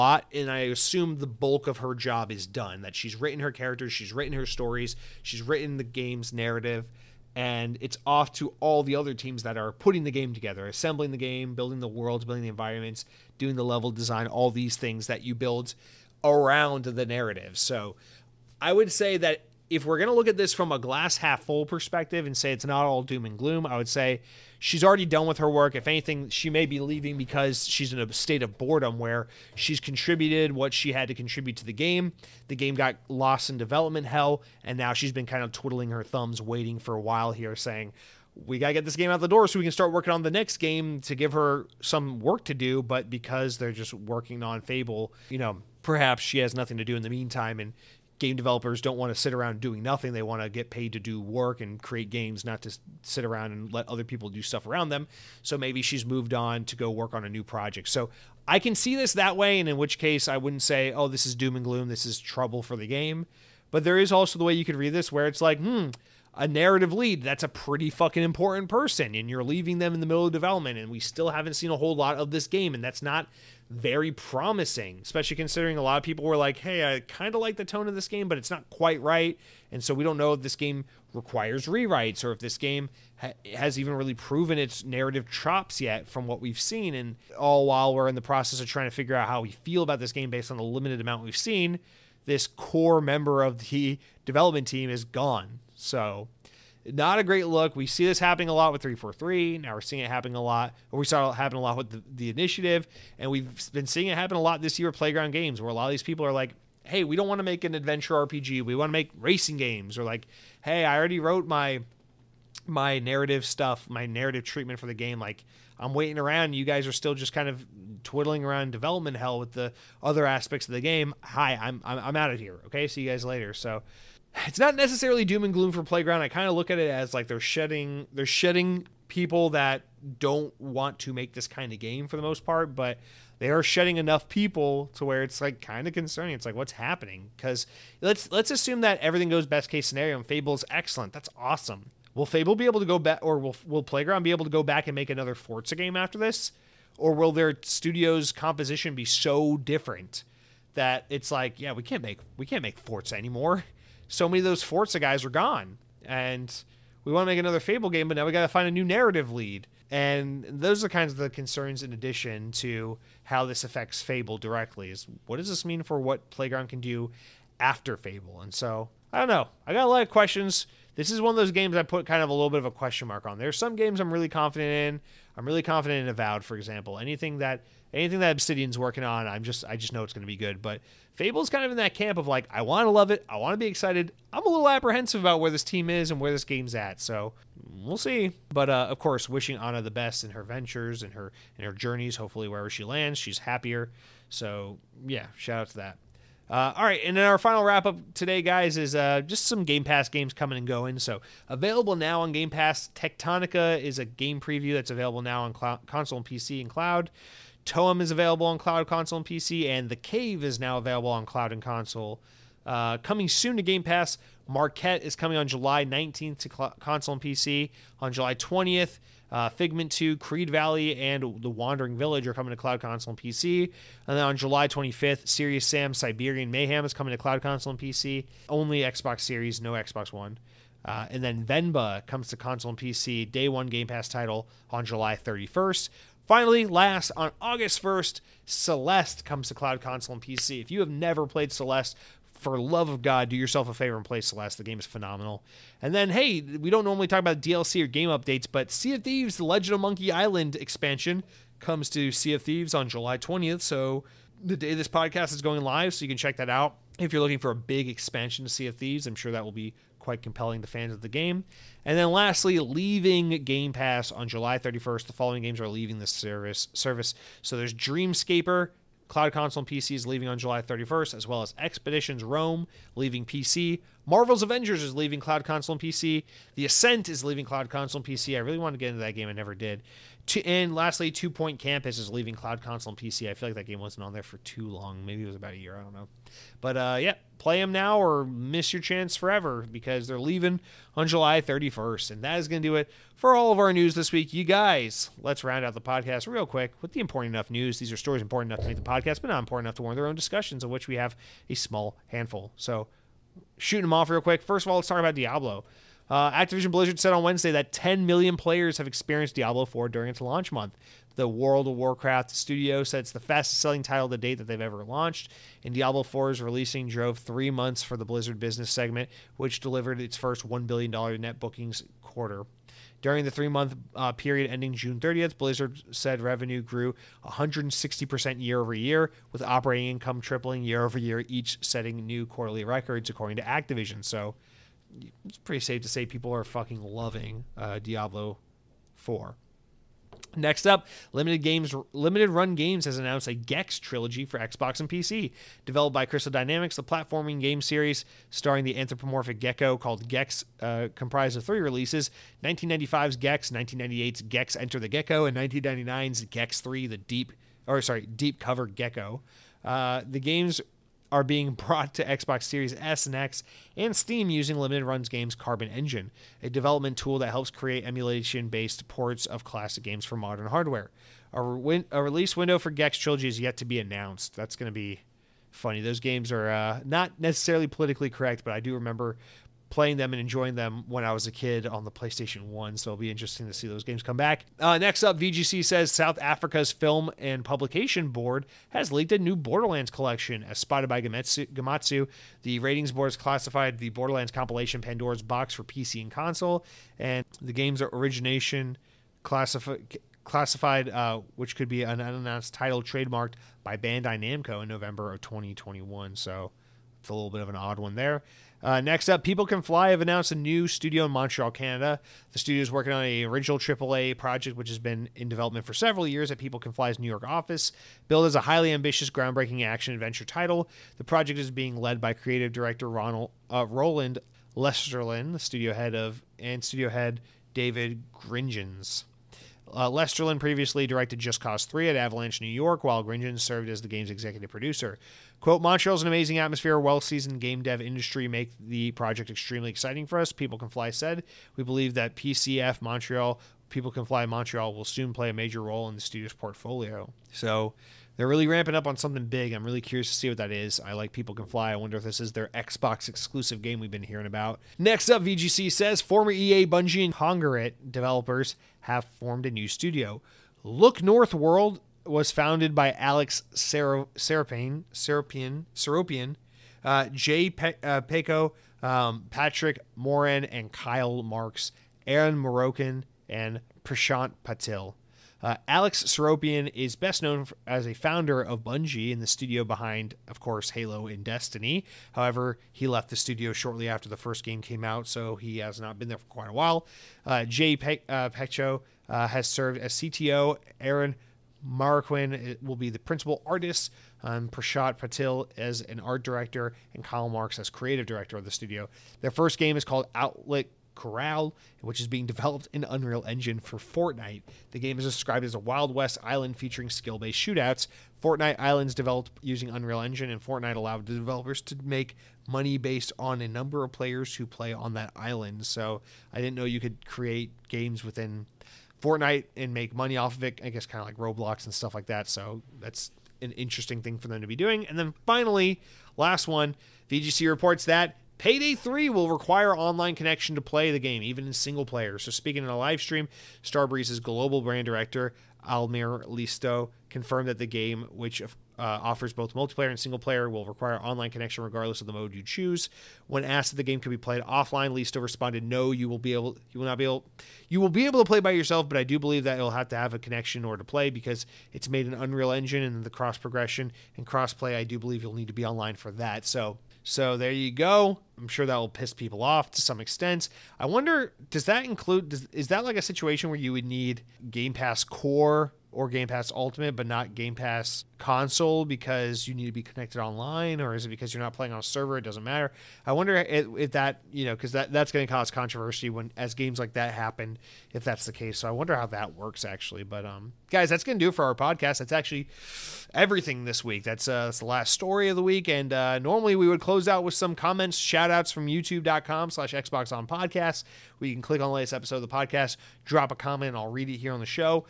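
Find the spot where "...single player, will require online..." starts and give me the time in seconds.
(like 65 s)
539 s.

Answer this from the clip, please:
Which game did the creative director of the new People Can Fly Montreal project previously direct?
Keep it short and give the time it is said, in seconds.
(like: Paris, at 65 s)
Just Cause 3, at 431 s.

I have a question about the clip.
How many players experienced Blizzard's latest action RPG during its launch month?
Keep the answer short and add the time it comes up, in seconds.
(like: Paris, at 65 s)
10 million, at 307 s.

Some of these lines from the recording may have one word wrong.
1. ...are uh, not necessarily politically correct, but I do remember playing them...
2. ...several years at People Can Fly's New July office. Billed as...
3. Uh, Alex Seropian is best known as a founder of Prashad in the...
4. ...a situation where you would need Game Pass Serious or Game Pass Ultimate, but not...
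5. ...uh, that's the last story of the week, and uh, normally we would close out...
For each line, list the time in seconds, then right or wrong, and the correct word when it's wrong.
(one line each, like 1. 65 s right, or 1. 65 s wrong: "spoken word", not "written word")
1. 376 s right
2. 415 s wrong: "York", not "July"
3. 475 s wrong: "Bungie", not "Prashad"
4. 562 s wrong: "Core", not "Serious"
5. 584 s right.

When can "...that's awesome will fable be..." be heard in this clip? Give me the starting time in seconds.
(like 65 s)
141 s.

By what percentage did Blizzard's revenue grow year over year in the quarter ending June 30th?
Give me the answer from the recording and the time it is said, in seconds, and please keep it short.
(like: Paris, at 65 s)
160%, at 327 s.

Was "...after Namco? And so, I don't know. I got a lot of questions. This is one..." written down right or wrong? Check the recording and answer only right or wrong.
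wrong.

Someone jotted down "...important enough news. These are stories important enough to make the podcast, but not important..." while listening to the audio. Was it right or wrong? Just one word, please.
right.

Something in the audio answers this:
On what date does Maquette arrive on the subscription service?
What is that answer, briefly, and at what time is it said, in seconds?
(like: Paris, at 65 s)
July 19th, at 215 s.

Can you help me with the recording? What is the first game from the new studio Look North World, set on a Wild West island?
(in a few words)
Outlaw Corral.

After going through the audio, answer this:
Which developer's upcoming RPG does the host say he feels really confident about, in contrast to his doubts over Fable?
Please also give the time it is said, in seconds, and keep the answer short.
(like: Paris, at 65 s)
Avowed, at 176 s.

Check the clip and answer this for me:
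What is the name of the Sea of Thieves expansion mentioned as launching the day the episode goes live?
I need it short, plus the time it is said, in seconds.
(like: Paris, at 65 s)
The Legend of Monkey Island, at 249 s.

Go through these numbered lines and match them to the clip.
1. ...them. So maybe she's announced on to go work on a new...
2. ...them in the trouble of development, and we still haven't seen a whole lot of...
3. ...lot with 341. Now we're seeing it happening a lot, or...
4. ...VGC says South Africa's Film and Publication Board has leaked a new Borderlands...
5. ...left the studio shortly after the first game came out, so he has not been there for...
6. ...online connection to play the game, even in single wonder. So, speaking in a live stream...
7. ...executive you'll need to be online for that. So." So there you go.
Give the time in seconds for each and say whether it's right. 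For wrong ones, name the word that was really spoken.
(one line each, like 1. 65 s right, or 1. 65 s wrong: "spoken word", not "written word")
1. 54 s wrong: "moved", not "announced"
2. 69 s wrong: "middle", not "trouble"
3. 98 s wrong: "343", not "341"
4. 385 s right
5. 482 s right
6. 529 s wrong: "player", not "wonder"
7. 554 s wrong: "believe", not "executive".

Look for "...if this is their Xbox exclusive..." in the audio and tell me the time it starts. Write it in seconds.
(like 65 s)
451 s.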